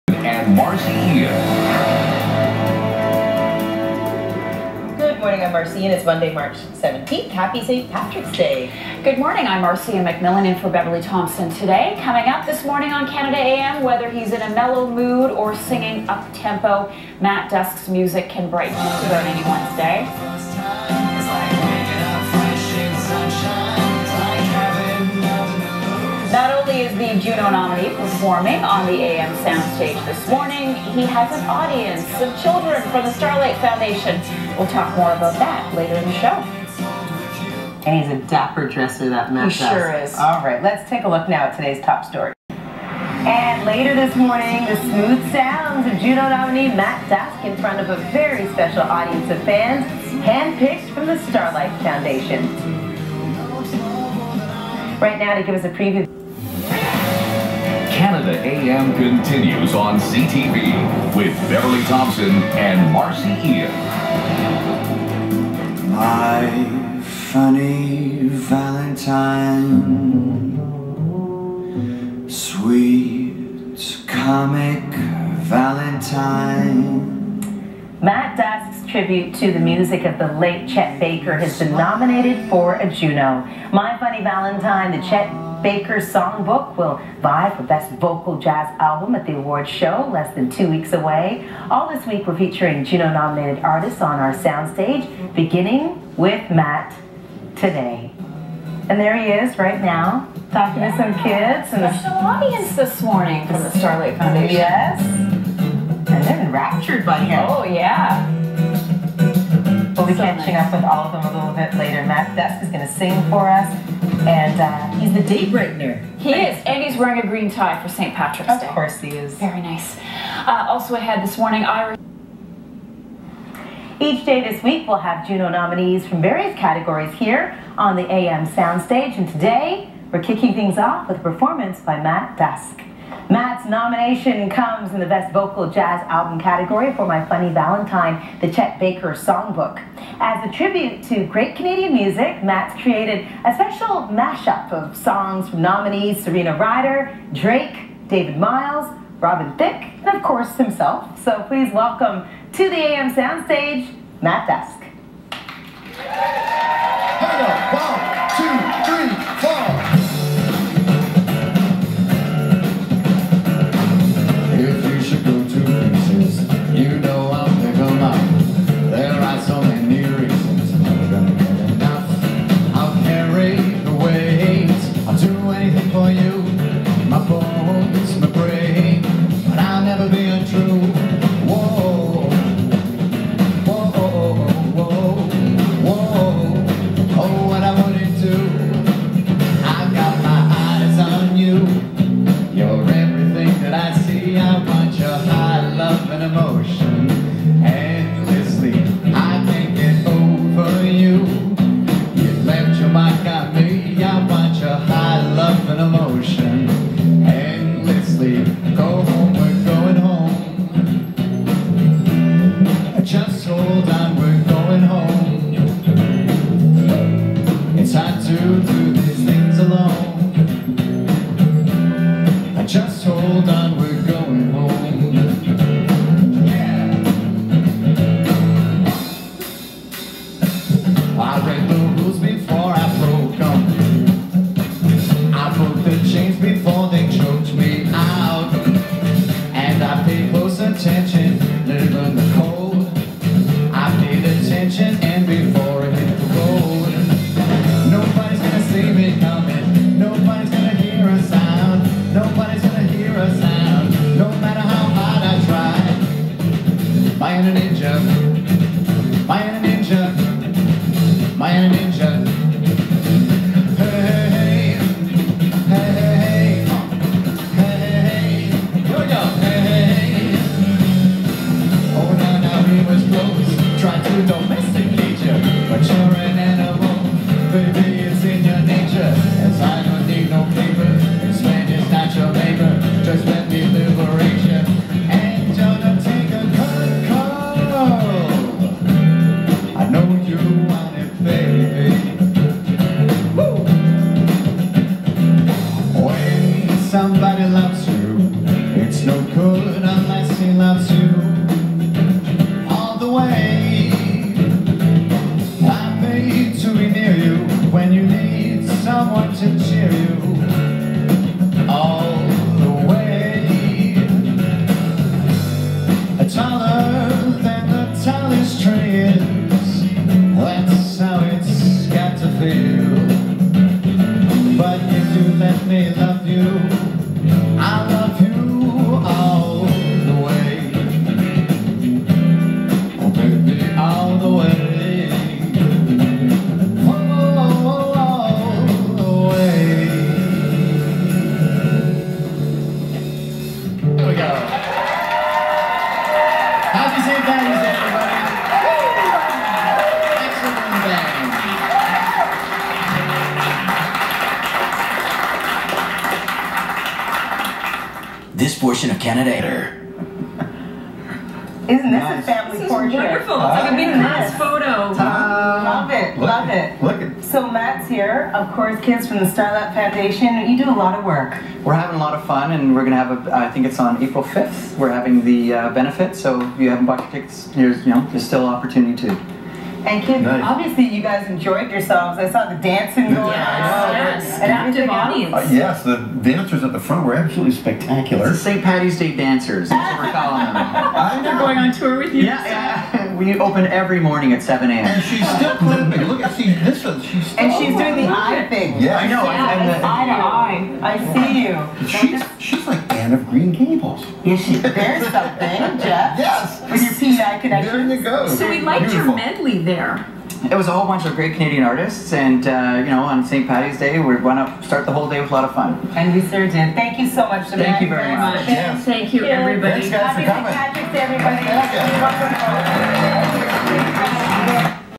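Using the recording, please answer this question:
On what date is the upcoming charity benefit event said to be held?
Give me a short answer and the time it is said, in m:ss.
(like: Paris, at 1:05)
April 5, at 6:14.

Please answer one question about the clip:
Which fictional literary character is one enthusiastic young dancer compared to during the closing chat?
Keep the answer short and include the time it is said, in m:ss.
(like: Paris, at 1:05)
Anne of Green Gables, at 6:42.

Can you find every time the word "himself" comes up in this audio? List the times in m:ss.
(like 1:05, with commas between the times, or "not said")
2:30.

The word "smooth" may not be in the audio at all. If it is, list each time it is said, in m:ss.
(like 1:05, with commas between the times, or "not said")
0:44.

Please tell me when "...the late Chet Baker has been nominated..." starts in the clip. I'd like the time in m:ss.
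1:20.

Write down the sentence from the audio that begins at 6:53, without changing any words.
Patty's Day, we want to start the whole day with a lot of fun.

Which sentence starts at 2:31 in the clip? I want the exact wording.
So please welcome to the AM Soundstage, Matt Dusk.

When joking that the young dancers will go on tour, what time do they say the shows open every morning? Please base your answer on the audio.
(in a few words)
7 a.m.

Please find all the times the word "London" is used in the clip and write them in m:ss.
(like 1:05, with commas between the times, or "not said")
not said.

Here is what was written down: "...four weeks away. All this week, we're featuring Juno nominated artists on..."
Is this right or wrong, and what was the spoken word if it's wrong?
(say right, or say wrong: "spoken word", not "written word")
wrong: "two", not "four".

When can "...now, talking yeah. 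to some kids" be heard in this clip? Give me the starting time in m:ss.
1:39.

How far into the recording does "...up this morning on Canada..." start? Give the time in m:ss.
0:12.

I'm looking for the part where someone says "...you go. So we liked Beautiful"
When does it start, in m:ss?
6:47.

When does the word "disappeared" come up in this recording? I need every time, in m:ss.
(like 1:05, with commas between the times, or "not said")
not said.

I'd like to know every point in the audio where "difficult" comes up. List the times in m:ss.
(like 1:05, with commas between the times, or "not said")
not said.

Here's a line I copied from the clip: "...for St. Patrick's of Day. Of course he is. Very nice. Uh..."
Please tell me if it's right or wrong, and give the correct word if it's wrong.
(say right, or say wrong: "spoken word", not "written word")
right.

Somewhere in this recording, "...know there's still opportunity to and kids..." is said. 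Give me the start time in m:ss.
6:17.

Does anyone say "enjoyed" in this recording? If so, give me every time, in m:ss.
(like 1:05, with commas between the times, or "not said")
6:21.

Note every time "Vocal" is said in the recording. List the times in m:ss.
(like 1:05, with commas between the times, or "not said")
1:27, 2:15.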